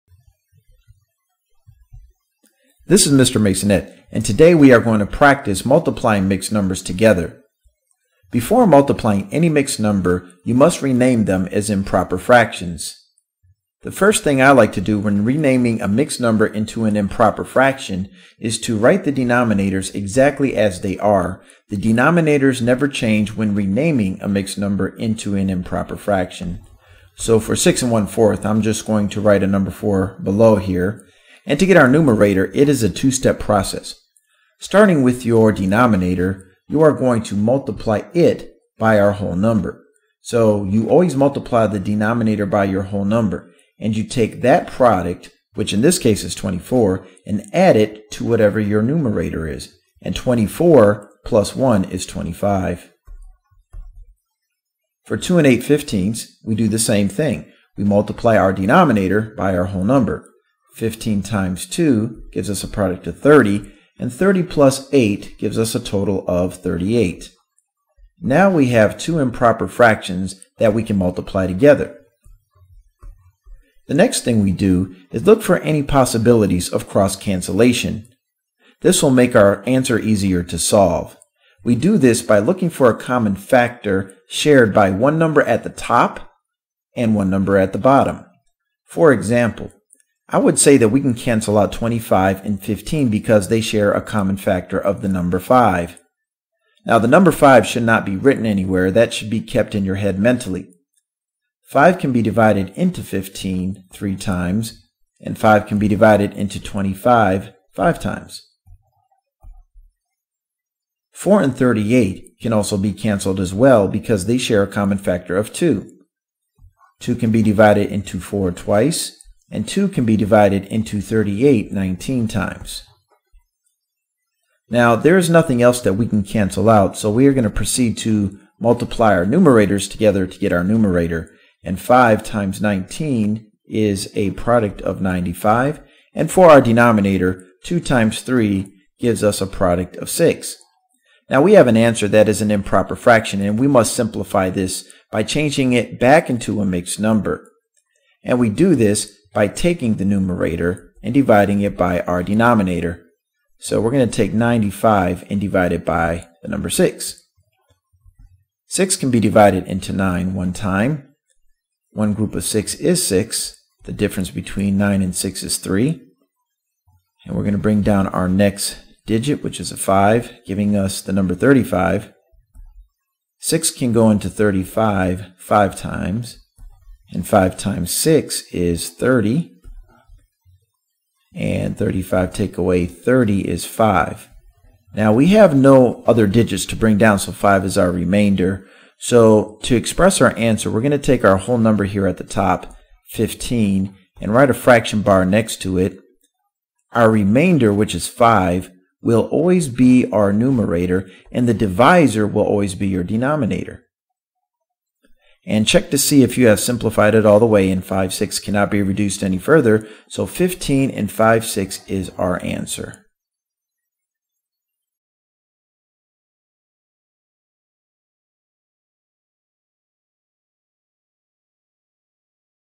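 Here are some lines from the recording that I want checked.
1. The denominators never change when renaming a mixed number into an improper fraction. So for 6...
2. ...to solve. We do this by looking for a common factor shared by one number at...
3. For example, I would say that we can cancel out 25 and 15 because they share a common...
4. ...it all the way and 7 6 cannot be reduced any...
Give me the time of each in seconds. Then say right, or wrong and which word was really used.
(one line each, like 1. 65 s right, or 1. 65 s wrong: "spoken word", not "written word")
1. 21 s right
2. 80 s right
3. 88 s right
4. 207 s wrong: "5", not "7".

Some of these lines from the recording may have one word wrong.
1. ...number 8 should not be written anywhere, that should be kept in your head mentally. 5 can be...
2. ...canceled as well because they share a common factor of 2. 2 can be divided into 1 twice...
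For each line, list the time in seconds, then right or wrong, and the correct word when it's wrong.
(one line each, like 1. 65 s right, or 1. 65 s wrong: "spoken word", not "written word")
1. 97 s wrong: "5", not "8"
2. 112 s wrong: "4", not "1".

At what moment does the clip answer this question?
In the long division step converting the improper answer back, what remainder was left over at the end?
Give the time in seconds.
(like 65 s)
187 s.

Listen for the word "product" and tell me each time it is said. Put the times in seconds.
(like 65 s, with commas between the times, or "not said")
44 s, 62 s, 134 s, 139 s.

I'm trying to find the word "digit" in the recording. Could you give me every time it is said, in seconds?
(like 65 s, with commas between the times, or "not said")
169 s, 186 s.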